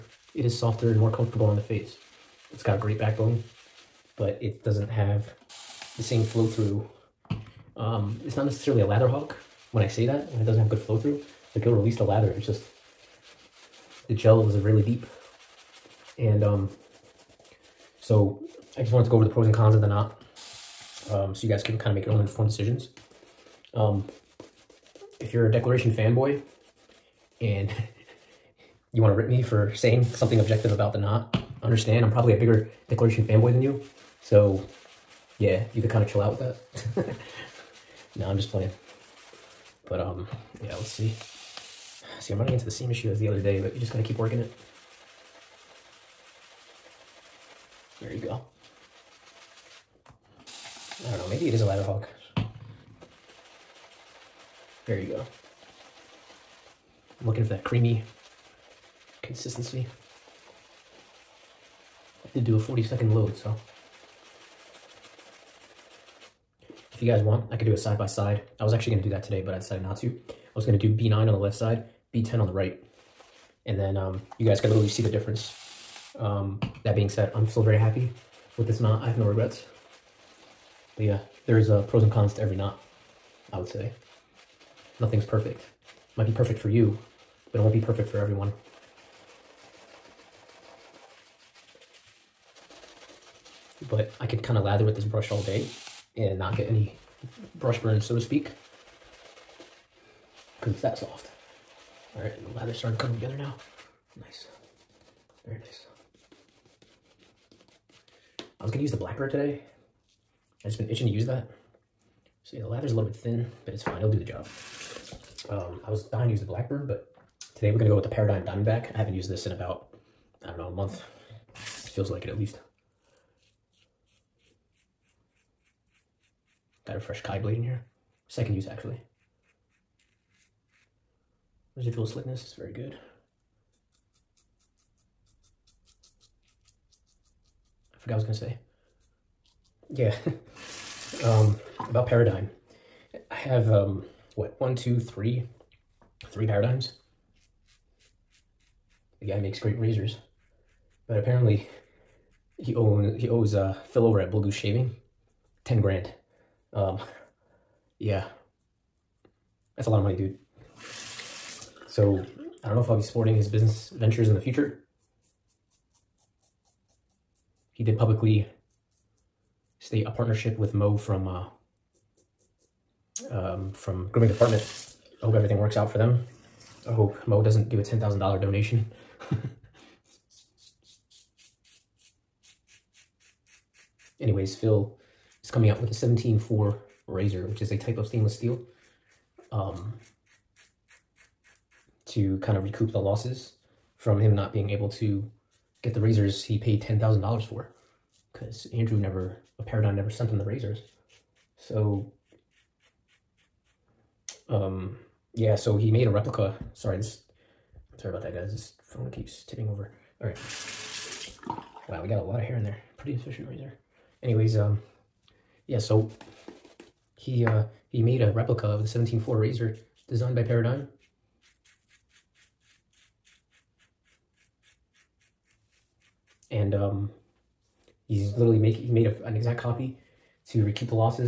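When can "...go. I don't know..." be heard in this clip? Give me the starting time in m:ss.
0:48.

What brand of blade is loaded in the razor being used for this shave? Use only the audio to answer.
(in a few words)
Kai.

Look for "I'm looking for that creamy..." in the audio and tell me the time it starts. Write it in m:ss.
0:57.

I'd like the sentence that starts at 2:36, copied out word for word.
Um, yeah, that's a lot of money, dude.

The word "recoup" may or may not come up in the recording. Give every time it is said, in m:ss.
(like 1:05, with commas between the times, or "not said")
3:12, 3:50.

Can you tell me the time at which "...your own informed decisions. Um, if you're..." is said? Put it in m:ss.
0:22.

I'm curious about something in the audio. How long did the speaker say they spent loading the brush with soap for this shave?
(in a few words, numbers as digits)
40 seconds.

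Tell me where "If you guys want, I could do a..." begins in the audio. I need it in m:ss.
1:06.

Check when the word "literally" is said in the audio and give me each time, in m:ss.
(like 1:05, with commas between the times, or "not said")
1:14, 3:48.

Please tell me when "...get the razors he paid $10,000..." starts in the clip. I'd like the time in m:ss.
3:15.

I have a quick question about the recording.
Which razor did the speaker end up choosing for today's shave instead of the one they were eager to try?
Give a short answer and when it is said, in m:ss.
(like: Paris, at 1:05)
Paradigm Diamondback, at 1:58.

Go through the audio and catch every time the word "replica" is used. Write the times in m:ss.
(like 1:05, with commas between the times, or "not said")
3:26, 3:38.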